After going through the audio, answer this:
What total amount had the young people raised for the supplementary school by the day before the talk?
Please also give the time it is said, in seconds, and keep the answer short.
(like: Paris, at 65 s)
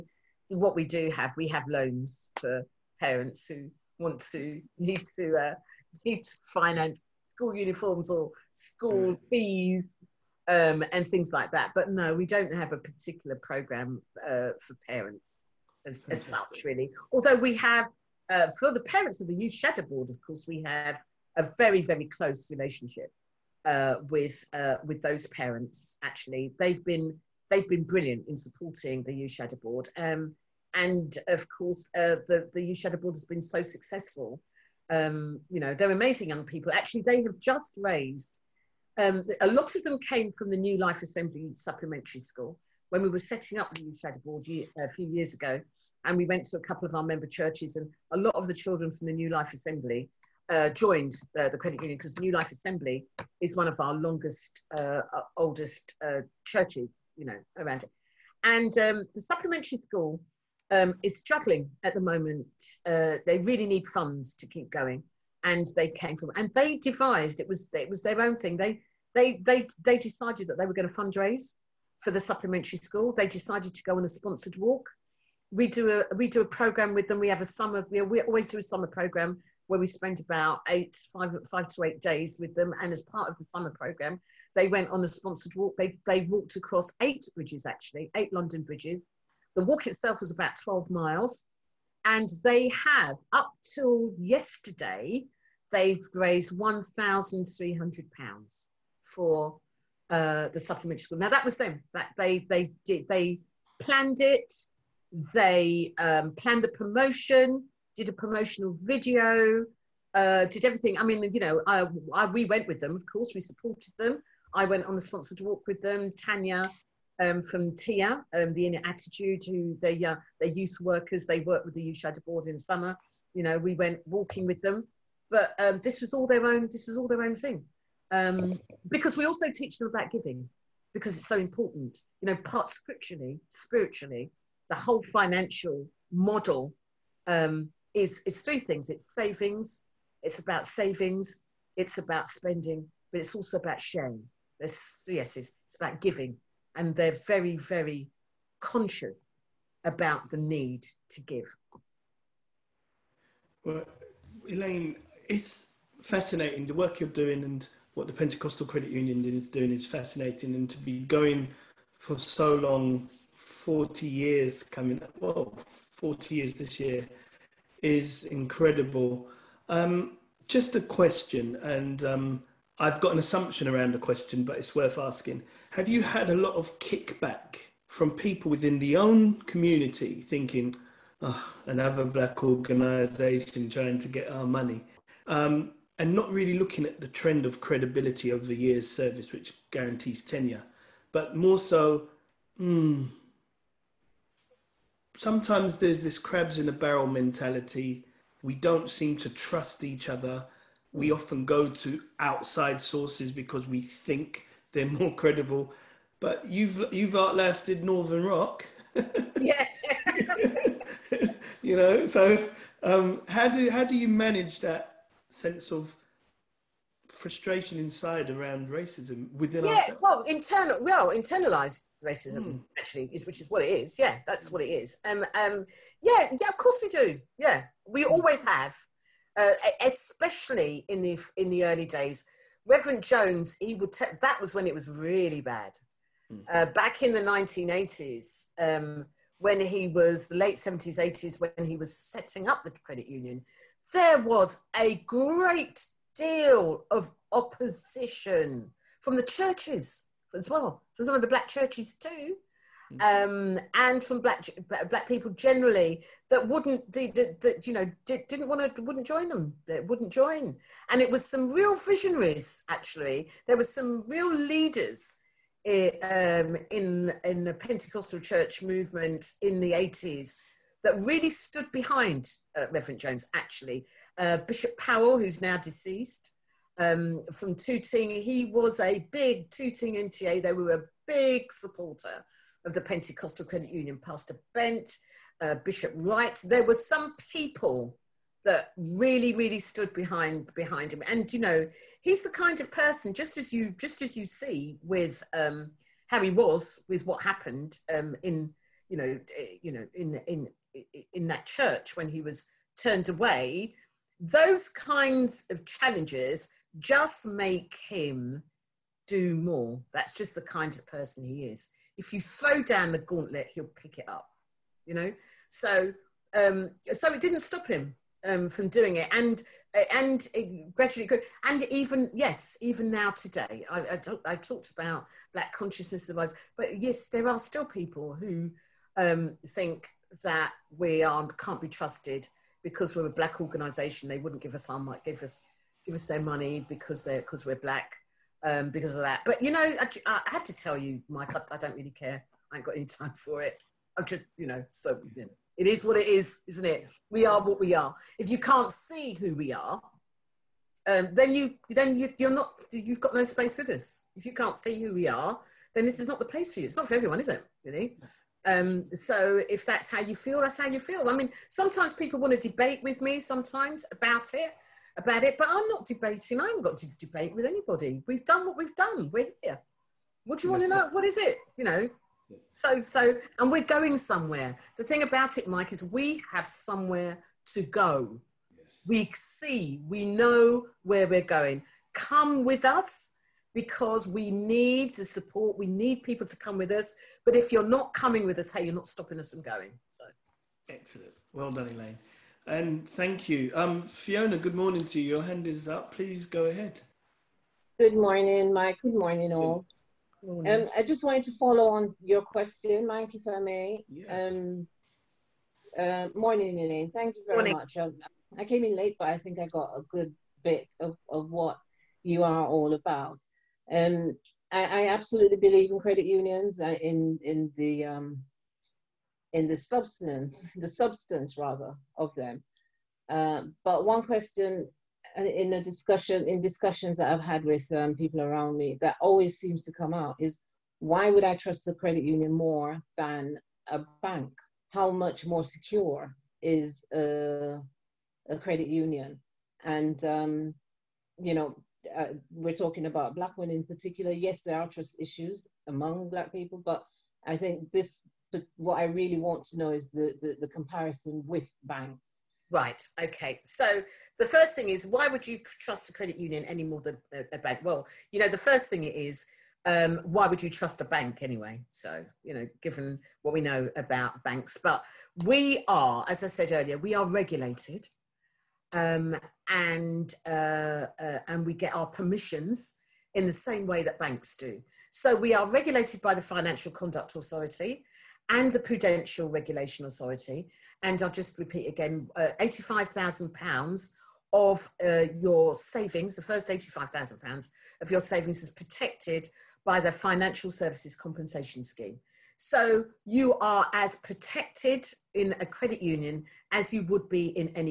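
£1,300, at 96 s.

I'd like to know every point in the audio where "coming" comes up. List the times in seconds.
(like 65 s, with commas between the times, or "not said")
164 s, 387 s.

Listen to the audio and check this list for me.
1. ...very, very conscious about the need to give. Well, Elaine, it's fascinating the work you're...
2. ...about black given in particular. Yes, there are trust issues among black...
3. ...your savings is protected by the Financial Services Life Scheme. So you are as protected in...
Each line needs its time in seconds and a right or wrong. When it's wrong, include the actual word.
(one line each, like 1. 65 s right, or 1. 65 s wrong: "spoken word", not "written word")
1. 147 s right
2. 442 s wrong: "women", not "given"
3. 487 s wrong: "Compensation", not "Life".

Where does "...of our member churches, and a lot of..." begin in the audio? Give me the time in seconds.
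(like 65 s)
46 s.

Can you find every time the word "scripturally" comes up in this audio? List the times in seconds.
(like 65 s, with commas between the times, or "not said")
132 s.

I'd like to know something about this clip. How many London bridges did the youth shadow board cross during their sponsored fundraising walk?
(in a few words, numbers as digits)
8.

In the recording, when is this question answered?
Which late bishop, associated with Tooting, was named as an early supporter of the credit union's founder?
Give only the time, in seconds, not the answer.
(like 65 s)
274 s.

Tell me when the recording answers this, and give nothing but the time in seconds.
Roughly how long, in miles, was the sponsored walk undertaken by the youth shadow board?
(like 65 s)
90 s.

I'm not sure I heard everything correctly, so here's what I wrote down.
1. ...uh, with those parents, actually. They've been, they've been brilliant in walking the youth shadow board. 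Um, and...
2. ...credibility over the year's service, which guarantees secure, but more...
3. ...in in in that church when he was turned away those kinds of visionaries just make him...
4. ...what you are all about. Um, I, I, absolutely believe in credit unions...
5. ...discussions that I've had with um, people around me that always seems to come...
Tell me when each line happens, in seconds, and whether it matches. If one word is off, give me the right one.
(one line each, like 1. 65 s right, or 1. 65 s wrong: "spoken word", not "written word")
1. 24 s wrong: "supporting", not "walking"
2. 187 s wrong: "tenure", not "secure"
3. 299 s wrong: "challenges", not "visionaries"
4. 411 s right
5. 426 s right.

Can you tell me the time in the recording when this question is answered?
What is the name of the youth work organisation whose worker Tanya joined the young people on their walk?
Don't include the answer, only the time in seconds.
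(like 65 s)
118 s.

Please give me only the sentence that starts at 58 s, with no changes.
And um, the supplementary school um, is struggling at the moment.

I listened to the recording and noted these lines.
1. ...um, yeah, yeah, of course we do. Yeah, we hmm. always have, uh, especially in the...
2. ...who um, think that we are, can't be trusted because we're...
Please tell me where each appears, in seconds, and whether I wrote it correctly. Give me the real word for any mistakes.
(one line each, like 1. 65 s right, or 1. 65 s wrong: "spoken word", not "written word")
1. 225 s right
2. 328 s right.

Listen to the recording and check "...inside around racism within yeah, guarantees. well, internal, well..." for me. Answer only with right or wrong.
wrong.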